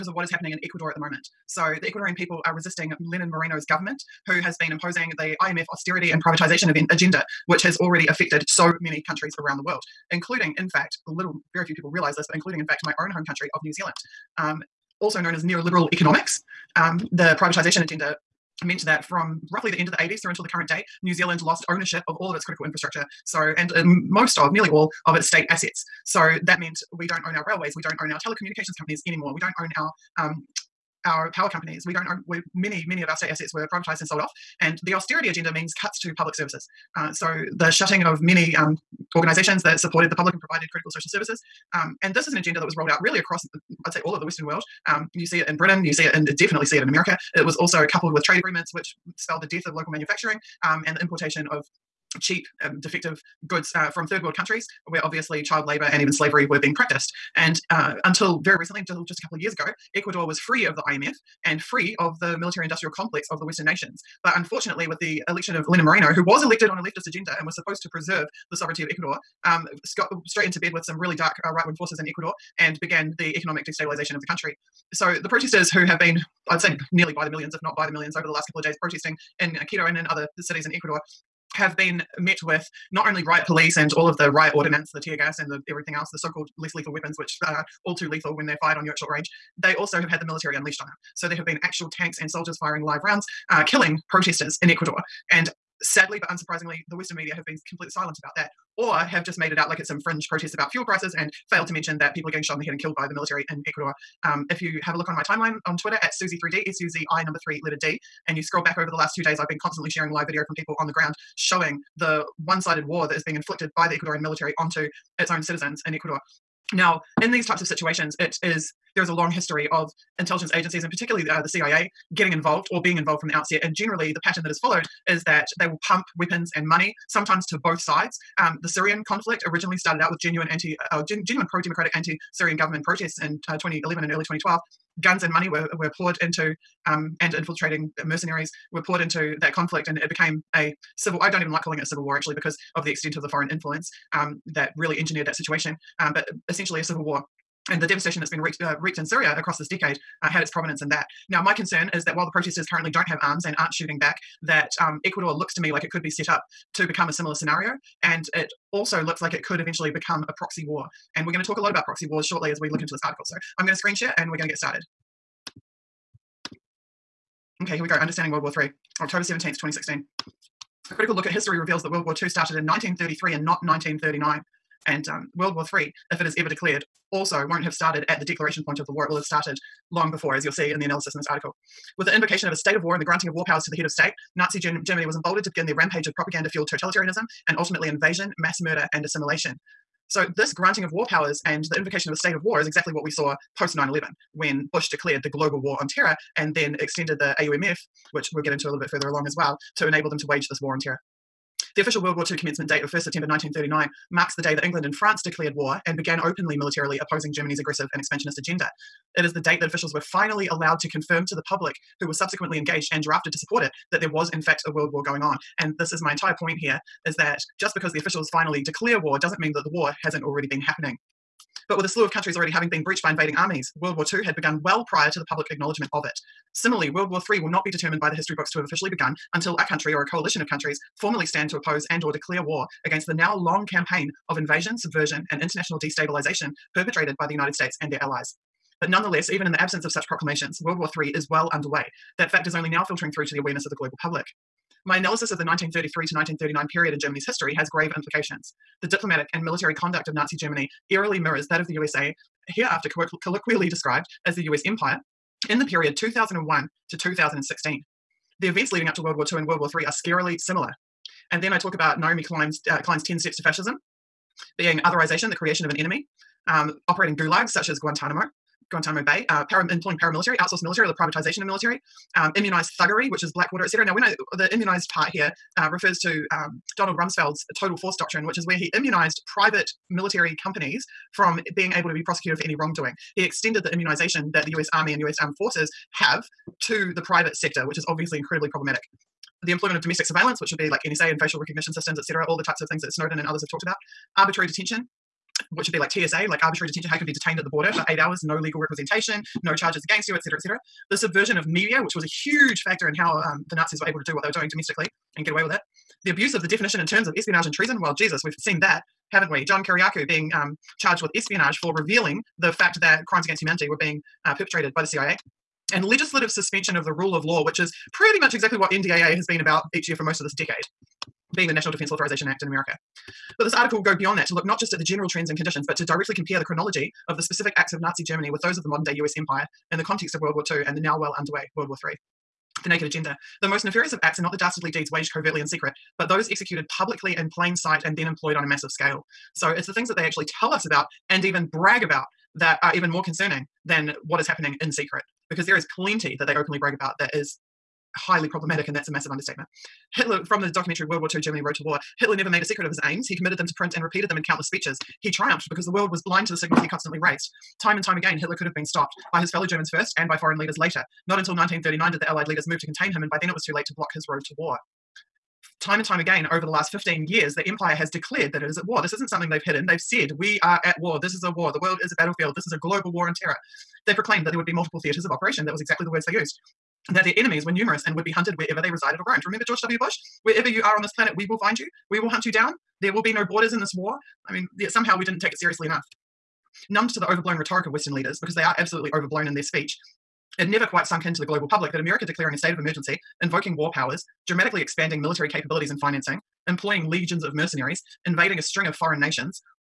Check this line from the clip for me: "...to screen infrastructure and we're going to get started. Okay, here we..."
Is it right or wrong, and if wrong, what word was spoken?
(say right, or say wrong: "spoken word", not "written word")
wrong: "share", not "infrastructure".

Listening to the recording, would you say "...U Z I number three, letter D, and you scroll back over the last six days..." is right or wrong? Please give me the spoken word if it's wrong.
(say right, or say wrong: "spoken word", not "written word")
wrong: "two", not "six".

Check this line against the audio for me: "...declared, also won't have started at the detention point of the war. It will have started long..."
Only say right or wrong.
wrong.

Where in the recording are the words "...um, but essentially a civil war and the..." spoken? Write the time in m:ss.
2:26.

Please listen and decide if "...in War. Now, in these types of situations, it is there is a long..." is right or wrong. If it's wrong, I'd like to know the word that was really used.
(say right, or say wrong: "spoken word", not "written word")
wrong: "Ecuador", not "War".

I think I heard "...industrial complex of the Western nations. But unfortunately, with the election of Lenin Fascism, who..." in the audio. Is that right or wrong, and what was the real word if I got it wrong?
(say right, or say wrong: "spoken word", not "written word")
wrong: "Moreno", not "Fascism".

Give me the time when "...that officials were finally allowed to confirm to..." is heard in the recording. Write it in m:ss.
3:29.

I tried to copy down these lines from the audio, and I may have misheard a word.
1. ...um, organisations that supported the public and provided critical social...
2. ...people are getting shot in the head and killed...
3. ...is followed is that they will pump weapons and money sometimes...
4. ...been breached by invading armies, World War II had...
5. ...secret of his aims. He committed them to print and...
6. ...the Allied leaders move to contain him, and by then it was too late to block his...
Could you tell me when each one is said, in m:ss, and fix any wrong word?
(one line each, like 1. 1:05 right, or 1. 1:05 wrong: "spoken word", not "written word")
1. 0:38 right
2. 1:42 right
3. 2:04 right
4. 3:42 right
5. 5:52 right
6. 6:02 right.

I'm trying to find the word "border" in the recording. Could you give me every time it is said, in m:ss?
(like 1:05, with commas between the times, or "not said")
4:57, 6:23.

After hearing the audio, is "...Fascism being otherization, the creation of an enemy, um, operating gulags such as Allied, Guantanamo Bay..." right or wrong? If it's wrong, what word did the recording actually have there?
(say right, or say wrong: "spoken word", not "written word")
wrong: "Guantanamo", not "Allied".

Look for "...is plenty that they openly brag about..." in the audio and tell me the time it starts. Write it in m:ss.
5:45.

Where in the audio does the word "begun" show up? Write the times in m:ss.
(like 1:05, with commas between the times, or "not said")
3:44, 3:48.